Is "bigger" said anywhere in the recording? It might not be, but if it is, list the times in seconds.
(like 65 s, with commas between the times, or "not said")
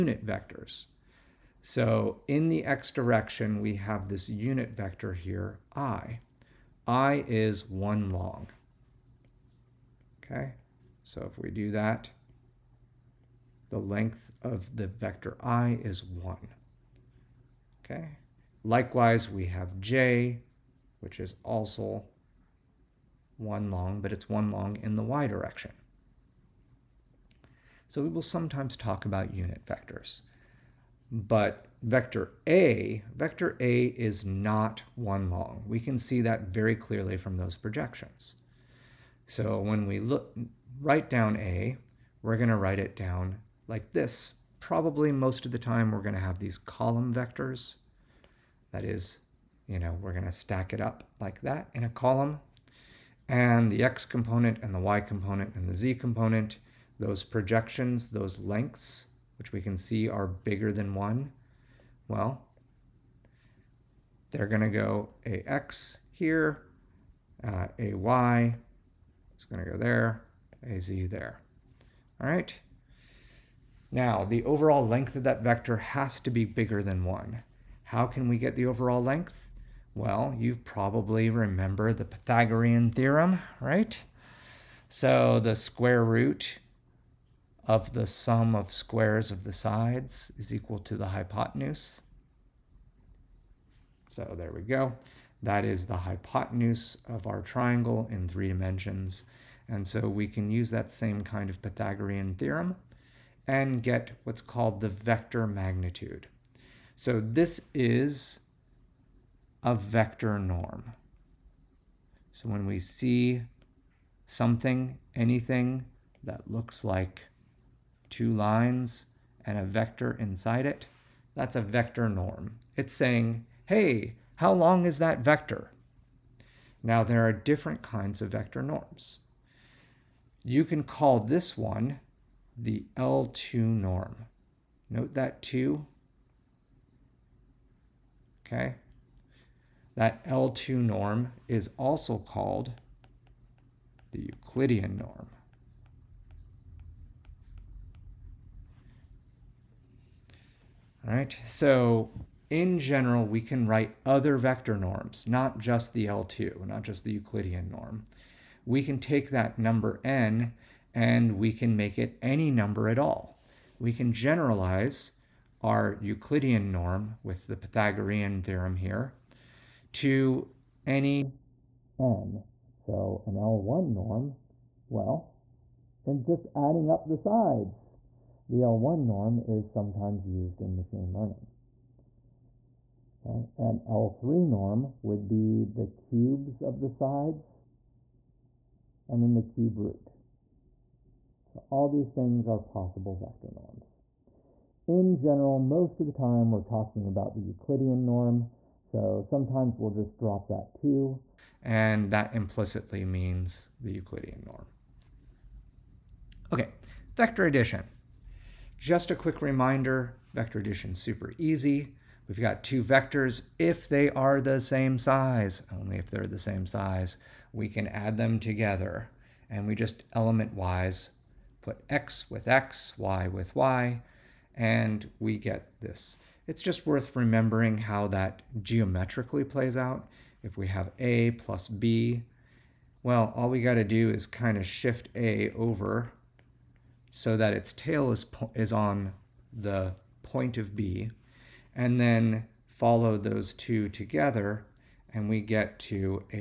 60 s, 76 s.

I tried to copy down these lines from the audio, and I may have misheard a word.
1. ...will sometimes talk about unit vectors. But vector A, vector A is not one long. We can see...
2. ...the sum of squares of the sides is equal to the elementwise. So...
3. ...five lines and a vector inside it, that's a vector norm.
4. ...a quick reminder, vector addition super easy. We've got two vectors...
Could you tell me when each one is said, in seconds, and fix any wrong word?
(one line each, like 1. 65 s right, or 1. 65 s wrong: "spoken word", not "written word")
1. 28 s right
2. 87 s wrong: "hypotenuse", not "elementwise"
3. 118 s wrong: "two", not "five"
4. 209 s right.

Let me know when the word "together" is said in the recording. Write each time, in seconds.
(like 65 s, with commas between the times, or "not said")
218 s, 243 s.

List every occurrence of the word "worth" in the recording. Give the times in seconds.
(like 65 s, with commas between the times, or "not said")
226 s.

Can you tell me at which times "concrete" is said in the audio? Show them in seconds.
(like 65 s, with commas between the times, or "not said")
not said.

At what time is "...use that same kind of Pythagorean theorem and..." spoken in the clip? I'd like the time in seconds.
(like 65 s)
100 s.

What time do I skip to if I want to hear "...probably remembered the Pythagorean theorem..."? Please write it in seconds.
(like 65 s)
80 s.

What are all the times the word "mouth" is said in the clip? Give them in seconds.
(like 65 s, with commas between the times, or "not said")
not said.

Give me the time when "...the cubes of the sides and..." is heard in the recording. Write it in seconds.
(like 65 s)
185 s.